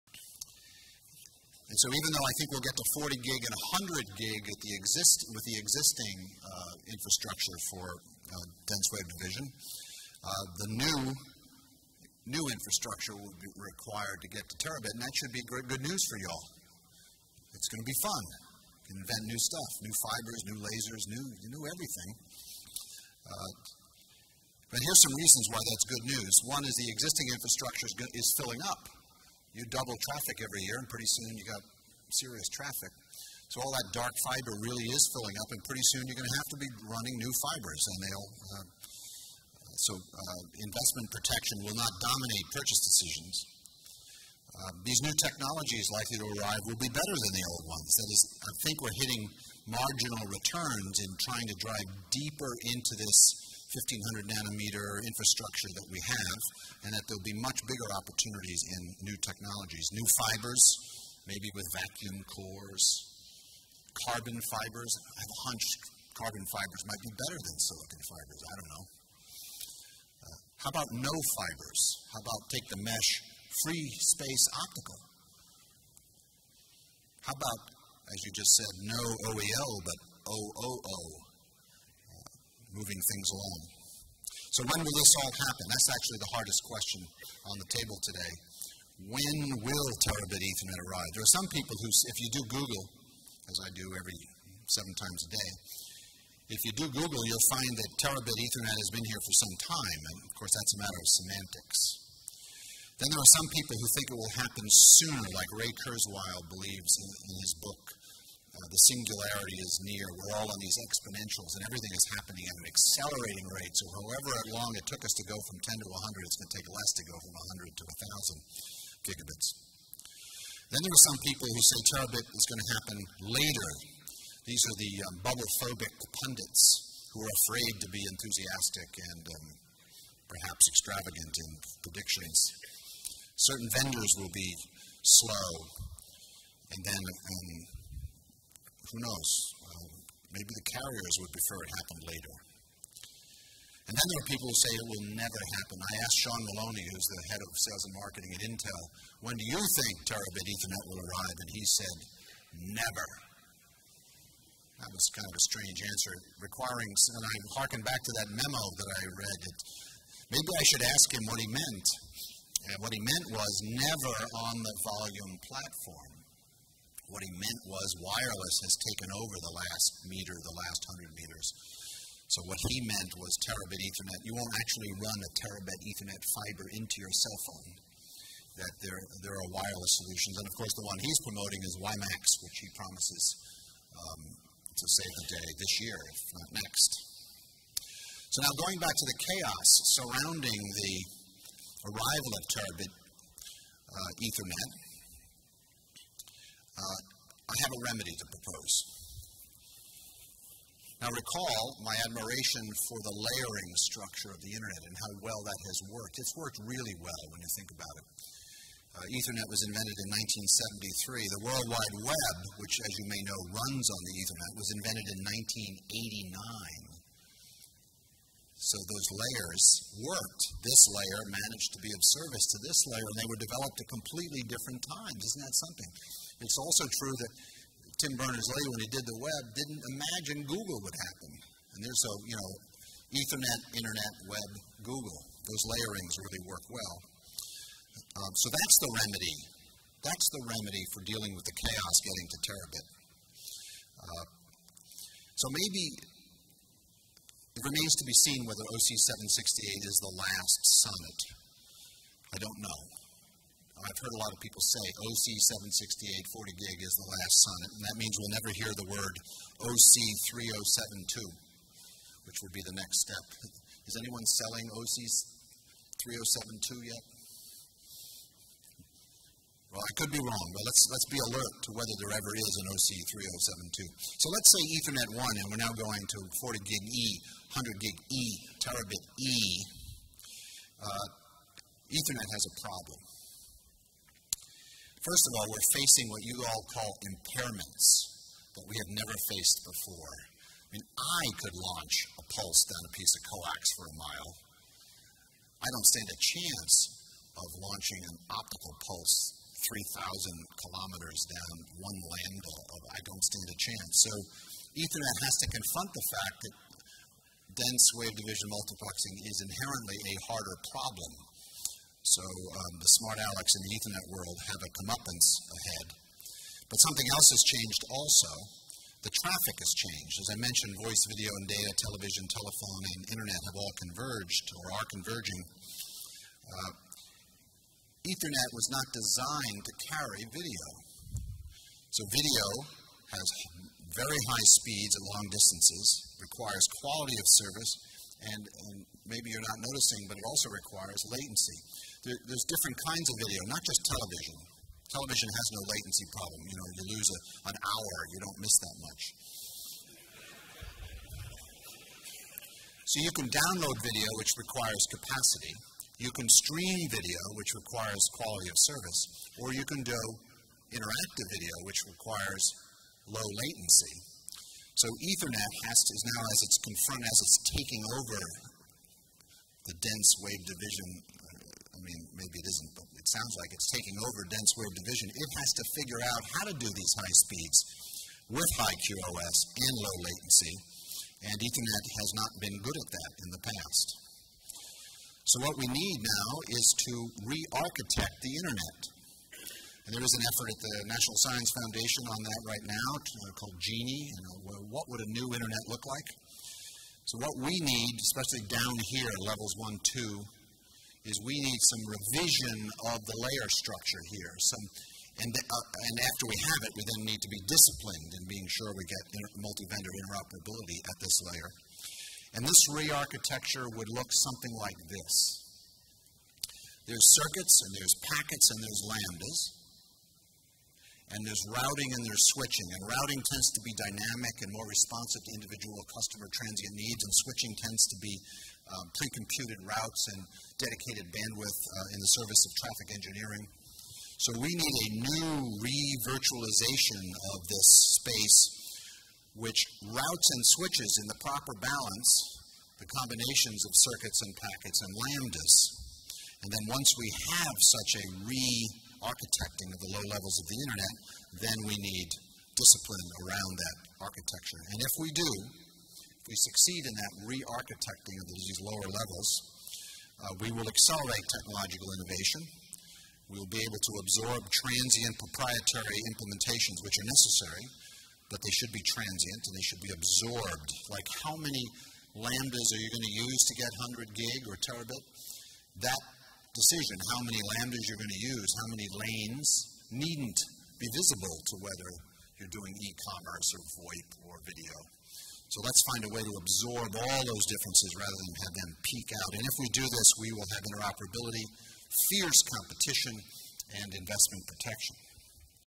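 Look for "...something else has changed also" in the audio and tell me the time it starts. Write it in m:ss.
5:16.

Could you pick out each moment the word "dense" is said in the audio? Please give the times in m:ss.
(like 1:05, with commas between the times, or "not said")
0:08, 5:07, 6:09, 6:14.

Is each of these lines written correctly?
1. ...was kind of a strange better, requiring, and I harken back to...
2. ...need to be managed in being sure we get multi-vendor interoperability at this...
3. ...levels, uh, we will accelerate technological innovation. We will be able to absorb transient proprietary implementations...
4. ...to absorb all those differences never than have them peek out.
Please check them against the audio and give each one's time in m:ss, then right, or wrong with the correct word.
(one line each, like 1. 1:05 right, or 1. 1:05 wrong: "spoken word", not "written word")
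1. 2:34 wrong: "answer", not "better"
2. 6:47 wrong: "disciplined", not "managed"
3. 7:38 right
4. 8:06 wrong: "rather", not "never".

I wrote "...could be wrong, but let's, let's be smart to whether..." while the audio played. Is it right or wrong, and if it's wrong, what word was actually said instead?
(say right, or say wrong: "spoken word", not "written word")
wrong: "alert", not "smart".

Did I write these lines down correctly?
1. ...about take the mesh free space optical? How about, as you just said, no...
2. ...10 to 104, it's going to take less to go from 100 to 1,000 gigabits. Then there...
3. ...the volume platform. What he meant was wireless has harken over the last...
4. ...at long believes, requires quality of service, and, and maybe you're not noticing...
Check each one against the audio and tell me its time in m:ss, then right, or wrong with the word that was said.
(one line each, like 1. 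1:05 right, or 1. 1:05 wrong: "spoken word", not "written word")
1. 1:12 right
2. 1:55 wrong: "100", not "104"
3. 2:44 wrong: "taken", not "harken"
4. 5:34 wrong: "distances", not "believes".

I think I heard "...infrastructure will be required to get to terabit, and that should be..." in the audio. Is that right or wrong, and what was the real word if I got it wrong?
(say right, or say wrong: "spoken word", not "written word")
right.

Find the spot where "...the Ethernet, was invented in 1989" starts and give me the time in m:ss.
3:34.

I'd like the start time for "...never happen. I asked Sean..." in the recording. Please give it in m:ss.
2:25.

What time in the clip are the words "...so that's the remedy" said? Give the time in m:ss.
3:58.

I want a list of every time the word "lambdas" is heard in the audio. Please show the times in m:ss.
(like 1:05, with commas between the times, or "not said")
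5:02, 6:58, 7:24, 7:52, 7:57.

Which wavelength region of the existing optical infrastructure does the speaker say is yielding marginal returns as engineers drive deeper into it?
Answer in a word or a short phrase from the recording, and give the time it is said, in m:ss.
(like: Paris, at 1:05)
1500 nanometer, at 0:53.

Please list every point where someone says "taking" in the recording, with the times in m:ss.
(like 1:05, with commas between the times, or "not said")
6:07, 6:13.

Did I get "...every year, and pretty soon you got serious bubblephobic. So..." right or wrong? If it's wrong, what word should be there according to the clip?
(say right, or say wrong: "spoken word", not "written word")
wrong: "traffic", not "bubblephobic".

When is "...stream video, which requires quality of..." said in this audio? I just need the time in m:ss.
5:56.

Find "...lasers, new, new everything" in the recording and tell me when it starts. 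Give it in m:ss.
0:20.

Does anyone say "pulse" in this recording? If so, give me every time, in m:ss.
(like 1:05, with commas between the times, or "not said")
4:52, 4:58.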